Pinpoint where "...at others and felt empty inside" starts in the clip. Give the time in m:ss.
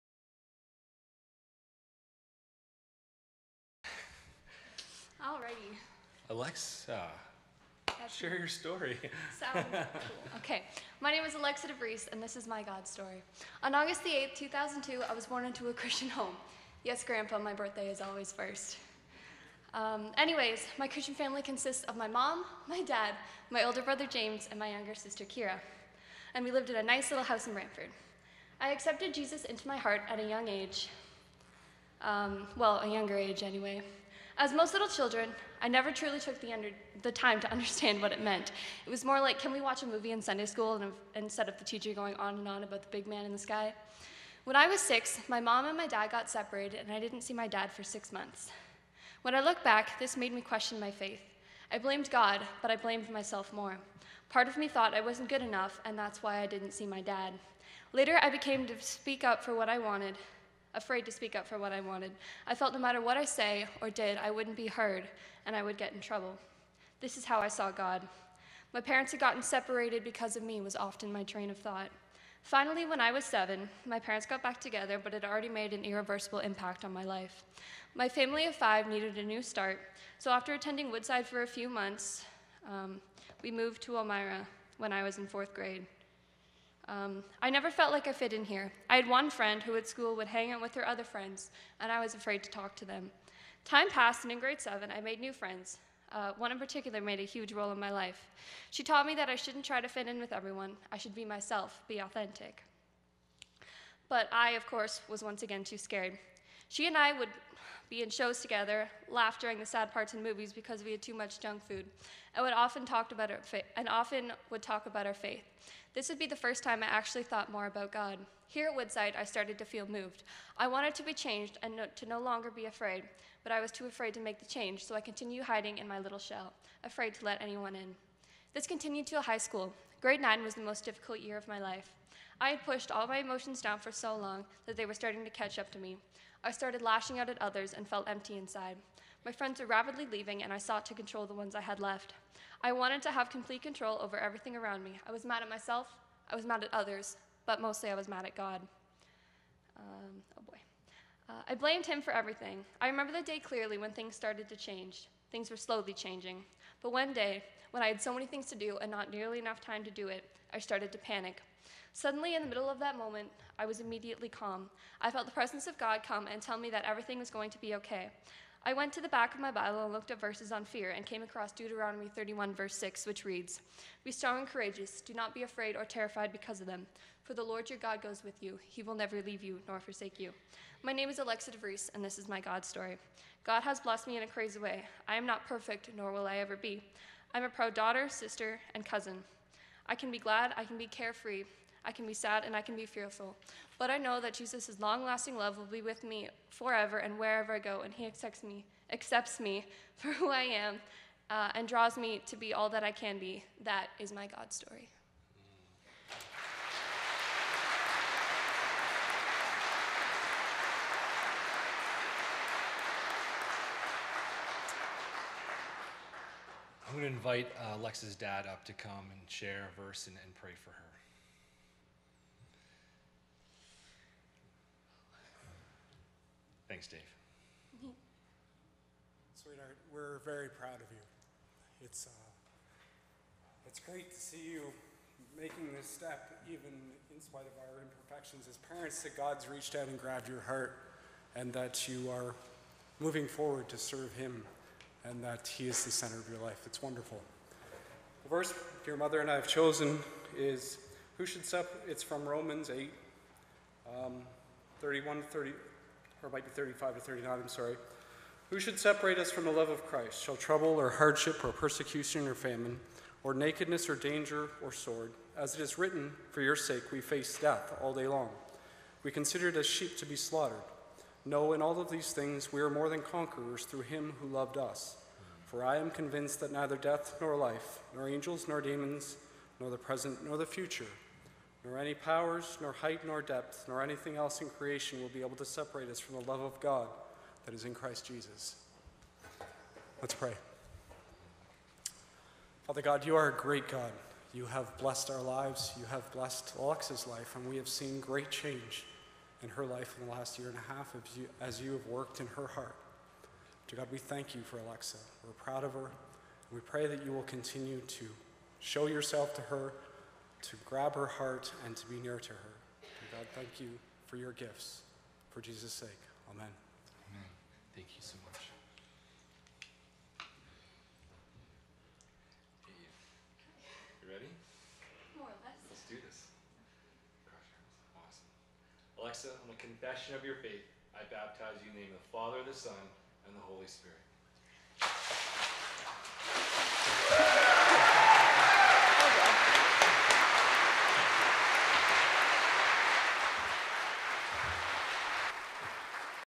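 2:17.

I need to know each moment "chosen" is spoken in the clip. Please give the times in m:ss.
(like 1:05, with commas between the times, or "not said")
4:09.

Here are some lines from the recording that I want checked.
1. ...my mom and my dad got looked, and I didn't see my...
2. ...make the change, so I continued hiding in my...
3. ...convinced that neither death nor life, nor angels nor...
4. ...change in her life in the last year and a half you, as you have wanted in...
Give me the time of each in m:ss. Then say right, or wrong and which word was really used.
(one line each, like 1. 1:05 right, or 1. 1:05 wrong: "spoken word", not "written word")
1. 0:45 wrong: "separated", not "looked"
2. 2:04 right
3. 4:35 right
4. 4:58 wrong: "worked", not "wanted".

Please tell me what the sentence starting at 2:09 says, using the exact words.
Grade 9 was the most difficult year of my life.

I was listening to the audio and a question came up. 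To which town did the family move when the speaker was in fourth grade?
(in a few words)
Elmira.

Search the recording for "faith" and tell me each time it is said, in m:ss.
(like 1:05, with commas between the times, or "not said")
0:50, 1:55, 5:30.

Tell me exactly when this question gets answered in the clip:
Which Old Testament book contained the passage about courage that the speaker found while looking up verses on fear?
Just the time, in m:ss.
2:51.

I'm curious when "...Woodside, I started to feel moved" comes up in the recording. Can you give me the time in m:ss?
1:58.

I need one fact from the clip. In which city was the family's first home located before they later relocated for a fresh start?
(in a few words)
Brantford.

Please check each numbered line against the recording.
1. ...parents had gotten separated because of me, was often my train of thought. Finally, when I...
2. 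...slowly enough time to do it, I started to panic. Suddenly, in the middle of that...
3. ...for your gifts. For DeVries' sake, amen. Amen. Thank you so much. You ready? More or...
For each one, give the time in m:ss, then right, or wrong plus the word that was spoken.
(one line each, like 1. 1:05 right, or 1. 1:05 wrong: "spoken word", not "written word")
1. 1:08 right
2. 2:39 wrong: "nearly", not "slowly"
3. 5:14 wrong: "Jesus", not "DeVries".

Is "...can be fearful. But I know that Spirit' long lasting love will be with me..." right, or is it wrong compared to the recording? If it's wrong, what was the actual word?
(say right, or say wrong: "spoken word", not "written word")
wrong: "Jesus", not "Spirit".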